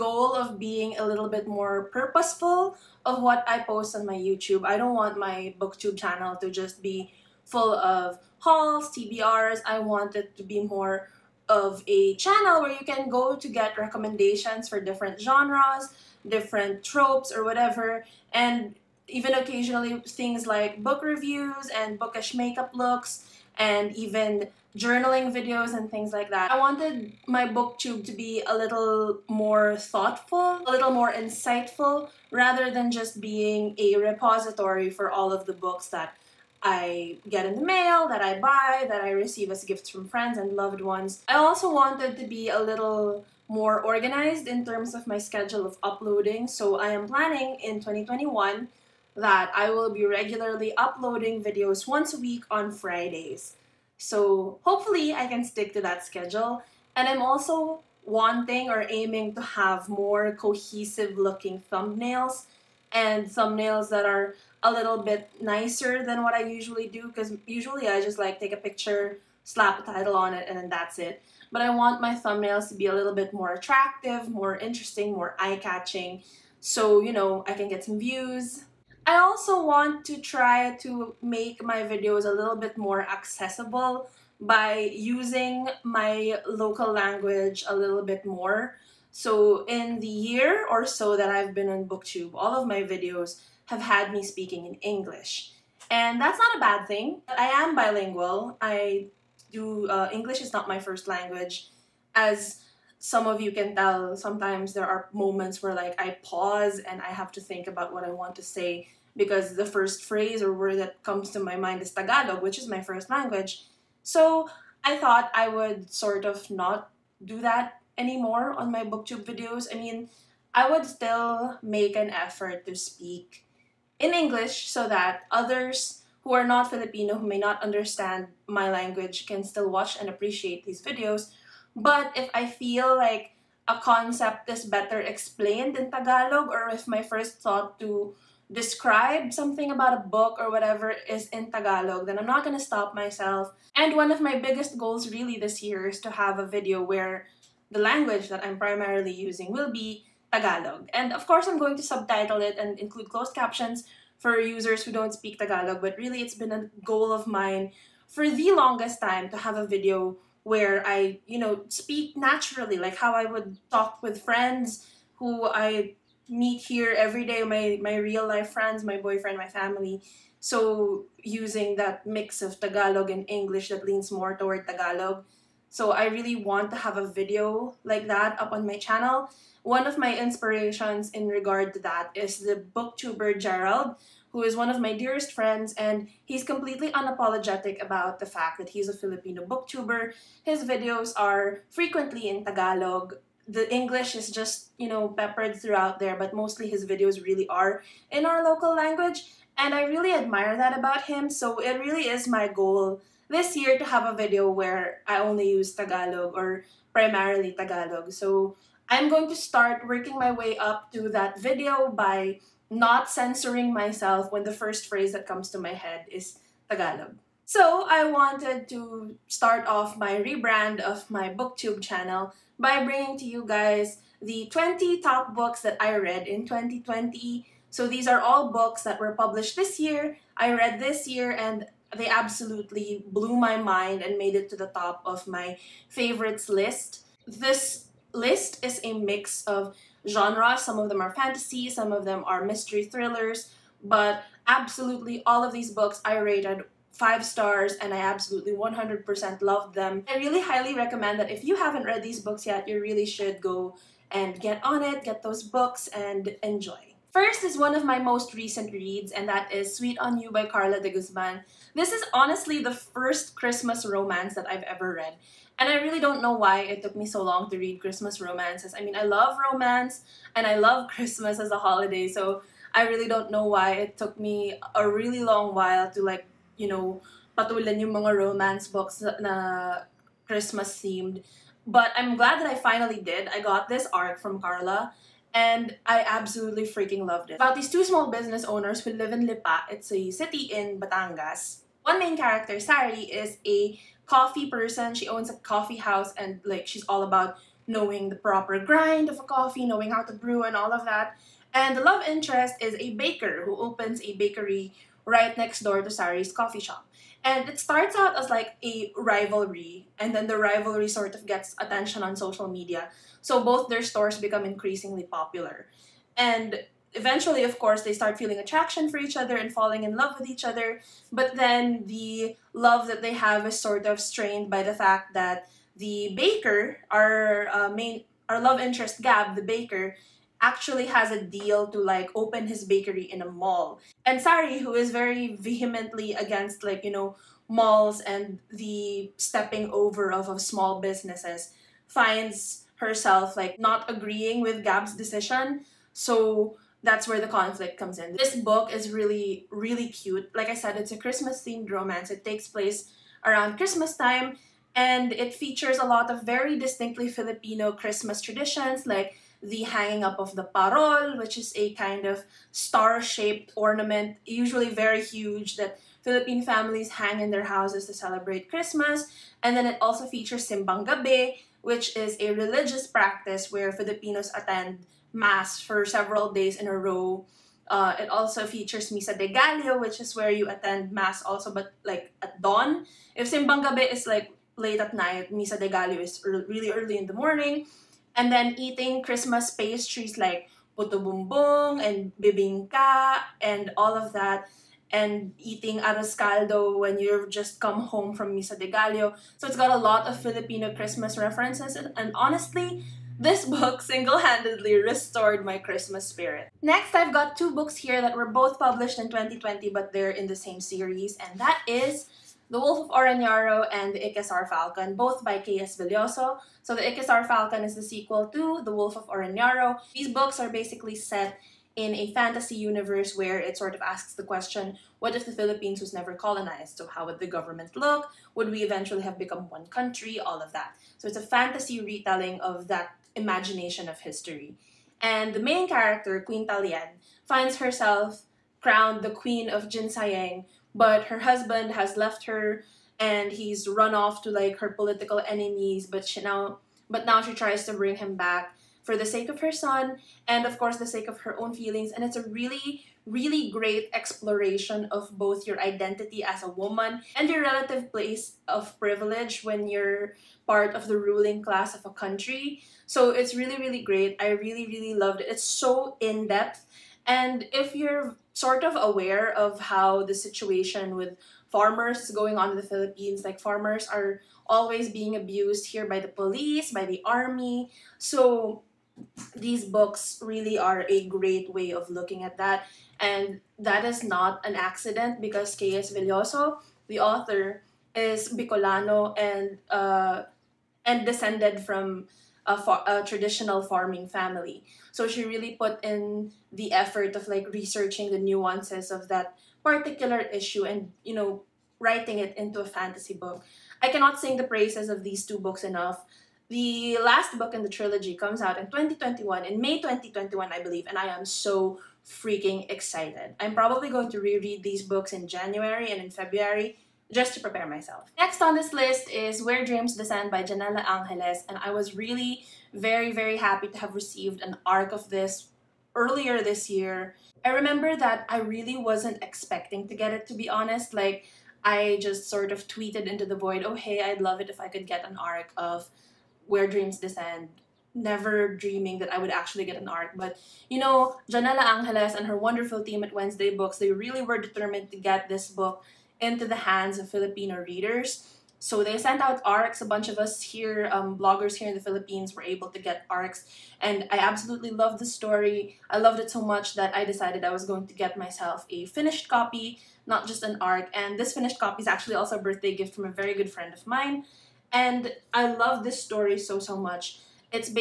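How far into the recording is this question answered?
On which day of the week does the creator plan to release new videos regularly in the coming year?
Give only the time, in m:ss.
0:52.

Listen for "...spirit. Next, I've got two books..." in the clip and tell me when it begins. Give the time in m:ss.
6:46.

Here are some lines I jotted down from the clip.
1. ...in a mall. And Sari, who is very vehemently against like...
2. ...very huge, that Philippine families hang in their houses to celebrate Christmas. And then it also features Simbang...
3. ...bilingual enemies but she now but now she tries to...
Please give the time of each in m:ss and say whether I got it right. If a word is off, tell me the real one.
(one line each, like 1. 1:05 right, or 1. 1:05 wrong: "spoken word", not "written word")
1. 5:33 right
2. 6:04 right
3. 7:24 wrong: "political", not "bilingual".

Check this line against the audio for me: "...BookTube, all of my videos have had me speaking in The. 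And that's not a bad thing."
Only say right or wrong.
wrong.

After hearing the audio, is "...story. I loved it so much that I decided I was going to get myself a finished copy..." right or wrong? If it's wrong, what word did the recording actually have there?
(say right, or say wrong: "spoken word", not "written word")
right.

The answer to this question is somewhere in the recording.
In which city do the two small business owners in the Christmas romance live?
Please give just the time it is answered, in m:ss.
4:49.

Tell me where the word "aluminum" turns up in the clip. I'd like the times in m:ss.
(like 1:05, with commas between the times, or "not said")
not said.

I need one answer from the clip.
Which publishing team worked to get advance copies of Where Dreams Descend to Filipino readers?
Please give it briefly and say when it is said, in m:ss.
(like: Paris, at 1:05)
Wednesday Books, at 9:03.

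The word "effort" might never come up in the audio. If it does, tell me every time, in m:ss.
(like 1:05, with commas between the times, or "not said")
2:02, 8:16.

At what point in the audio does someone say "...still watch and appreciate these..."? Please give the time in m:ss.
2:09.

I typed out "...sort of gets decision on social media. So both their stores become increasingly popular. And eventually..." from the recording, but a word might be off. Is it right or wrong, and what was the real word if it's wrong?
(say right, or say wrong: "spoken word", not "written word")
wrong: "attention", not "decision".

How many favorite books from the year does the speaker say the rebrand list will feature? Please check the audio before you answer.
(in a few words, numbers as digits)
20.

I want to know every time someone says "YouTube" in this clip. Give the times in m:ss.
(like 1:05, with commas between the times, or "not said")
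0:04.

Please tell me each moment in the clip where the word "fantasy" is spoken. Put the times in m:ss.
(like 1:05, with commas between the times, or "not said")
4:01, 7:02, 7:11, 8:22.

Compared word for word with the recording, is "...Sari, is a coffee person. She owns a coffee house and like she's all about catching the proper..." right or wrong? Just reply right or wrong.
wrong.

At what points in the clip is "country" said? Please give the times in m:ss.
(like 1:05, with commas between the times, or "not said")
7:09, 7:41.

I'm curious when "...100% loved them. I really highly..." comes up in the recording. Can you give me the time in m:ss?
4:08.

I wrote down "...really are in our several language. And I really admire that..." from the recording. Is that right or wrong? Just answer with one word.
wrong.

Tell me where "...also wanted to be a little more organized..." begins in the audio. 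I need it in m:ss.
0:41.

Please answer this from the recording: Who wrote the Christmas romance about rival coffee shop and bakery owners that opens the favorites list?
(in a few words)
Carla de Guzman.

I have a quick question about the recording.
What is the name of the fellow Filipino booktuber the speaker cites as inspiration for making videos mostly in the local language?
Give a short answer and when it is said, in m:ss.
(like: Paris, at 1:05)
Gerald, at 3:03.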